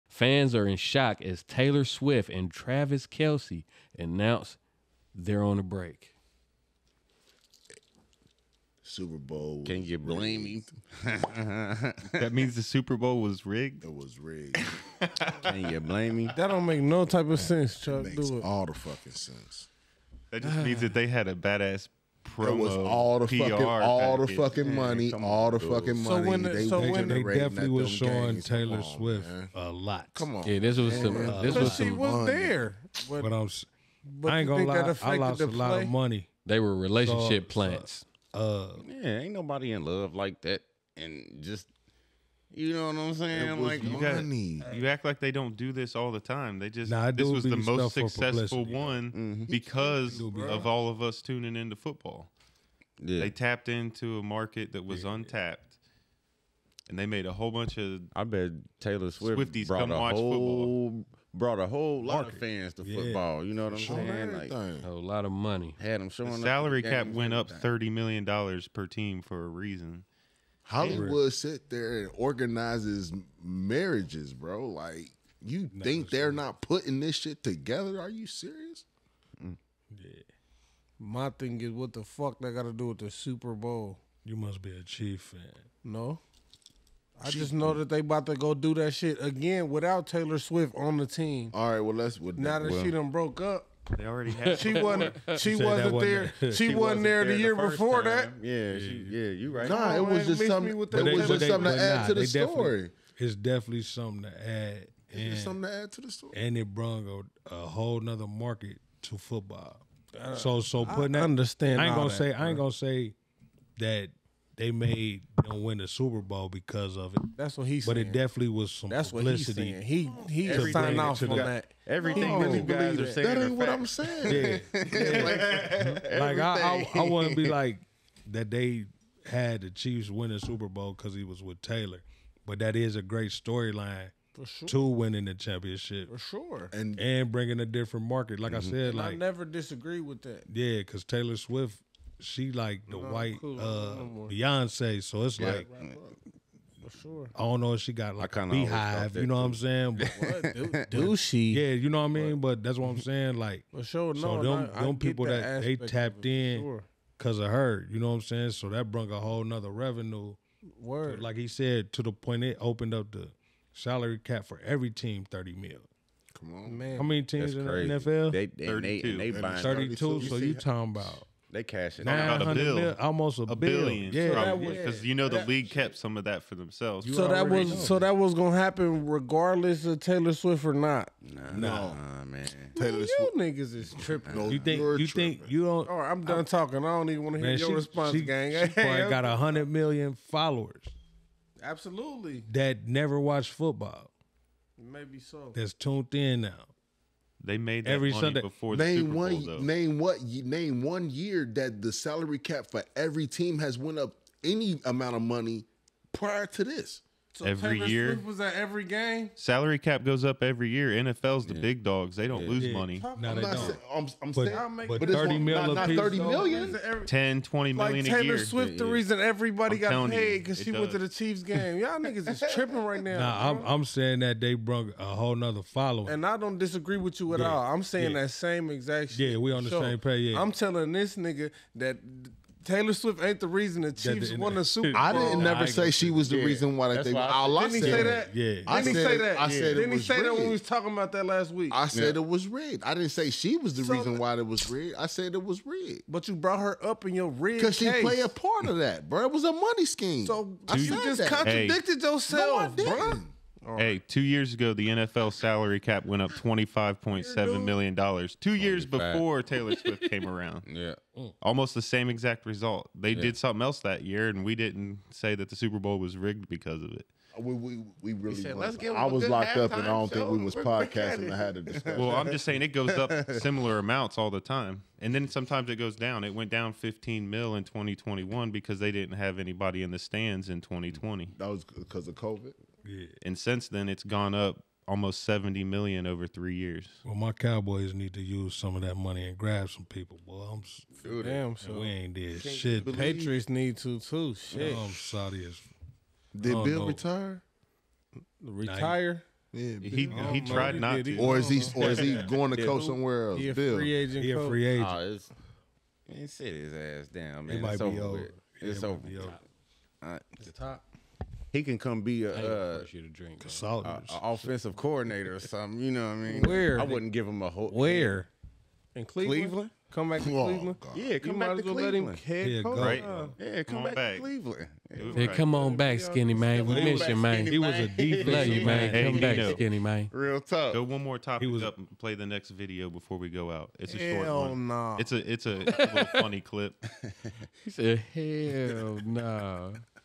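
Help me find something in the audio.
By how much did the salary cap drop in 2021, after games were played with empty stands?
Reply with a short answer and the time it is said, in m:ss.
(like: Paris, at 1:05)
15 million, at 4:36.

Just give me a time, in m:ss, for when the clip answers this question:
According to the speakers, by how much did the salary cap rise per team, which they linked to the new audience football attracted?
1:07.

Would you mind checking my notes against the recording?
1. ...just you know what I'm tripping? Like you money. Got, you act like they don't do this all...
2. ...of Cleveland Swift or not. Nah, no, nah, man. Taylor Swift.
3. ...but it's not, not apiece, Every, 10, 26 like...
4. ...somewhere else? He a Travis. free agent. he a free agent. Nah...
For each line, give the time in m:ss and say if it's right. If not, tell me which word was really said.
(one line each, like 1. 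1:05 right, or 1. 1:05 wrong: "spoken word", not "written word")
1. 0:41 wrong: "saying", not "tripping"
2. 2:59 wrong: "Taylor", not "Cleveland"
3. 3:34 wrong: "20", not "26"
4. 5:02 wrong: "Bill", not "Travis".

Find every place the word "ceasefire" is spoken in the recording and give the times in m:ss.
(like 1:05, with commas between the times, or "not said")
not said.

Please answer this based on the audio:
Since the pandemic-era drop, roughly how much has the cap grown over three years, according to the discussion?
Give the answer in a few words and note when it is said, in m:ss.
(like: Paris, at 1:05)
almost 70 million, at 4:44.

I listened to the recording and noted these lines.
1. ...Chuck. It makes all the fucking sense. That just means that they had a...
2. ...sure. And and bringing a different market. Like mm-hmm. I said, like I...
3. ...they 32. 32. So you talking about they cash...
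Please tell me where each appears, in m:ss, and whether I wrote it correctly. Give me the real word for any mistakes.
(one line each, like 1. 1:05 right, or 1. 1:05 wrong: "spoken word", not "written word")
1. 0:17 right
2. 2:16 right
3. 2:49 right.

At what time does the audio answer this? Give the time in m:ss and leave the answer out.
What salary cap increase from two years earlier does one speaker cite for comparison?
4:16.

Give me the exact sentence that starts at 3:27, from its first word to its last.
So every Taylor year Swift was at every game.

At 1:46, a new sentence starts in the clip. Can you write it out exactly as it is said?
And it brought a, a whole nother market to football.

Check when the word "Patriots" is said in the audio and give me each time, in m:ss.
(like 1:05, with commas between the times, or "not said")
4:52.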